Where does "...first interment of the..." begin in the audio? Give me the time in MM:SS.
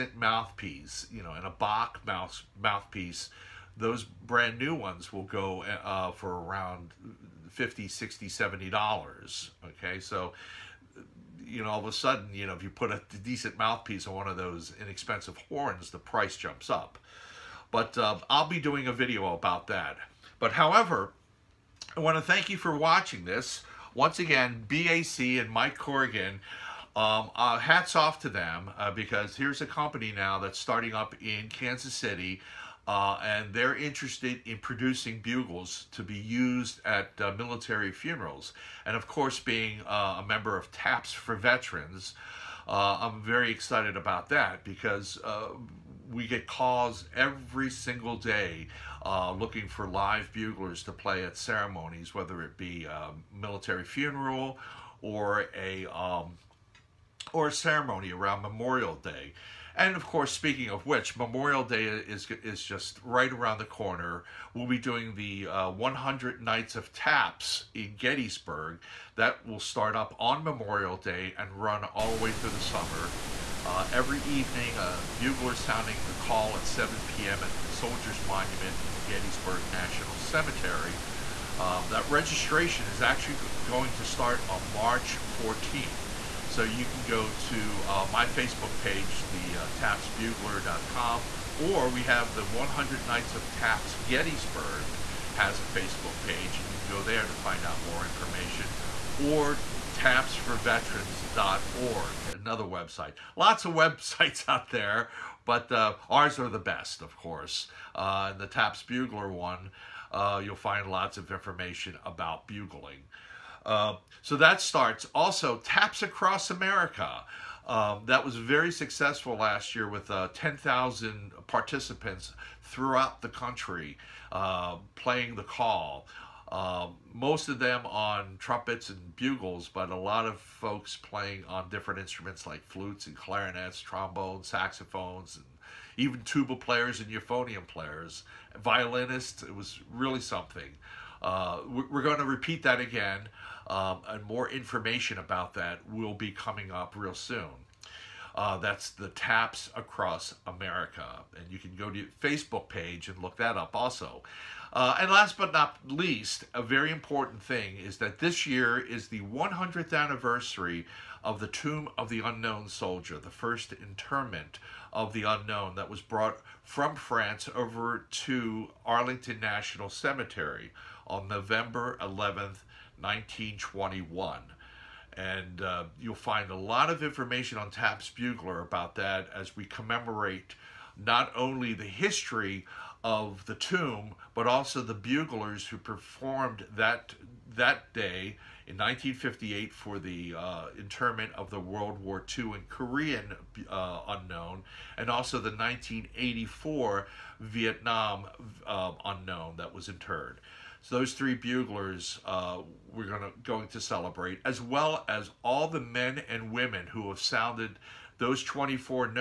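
02:43.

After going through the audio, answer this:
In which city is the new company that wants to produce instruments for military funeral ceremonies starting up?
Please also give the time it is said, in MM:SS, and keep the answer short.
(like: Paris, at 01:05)
Kansas City, at 00:31.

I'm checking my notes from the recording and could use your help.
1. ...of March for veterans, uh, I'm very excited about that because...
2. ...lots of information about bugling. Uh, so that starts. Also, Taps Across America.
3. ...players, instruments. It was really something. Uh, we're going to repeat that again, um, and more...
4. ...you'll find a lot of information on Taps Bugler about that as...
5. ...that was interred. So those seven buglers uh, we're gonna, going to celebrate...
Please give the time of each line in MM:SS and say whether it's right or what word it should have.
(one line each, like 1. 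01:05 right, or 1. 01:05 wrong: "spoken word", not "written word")
1. 00:40 wrong: "TAPS", not "March"
2. 01:50 right
3. 02:17 wrong: "violinists", not "instruments"
4. 02:55 right
5. 03:19 wrong: "three", not "seven".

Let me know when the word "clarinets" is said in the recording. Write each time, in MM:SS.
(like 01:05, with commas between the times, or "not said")
02:13.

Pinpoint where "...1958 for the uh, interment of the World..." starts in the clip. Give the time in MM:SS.
03:08.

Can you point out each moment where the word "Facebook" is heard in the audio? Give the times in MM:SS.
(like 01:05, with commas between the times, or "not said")
01:28, 01:35, 02:32.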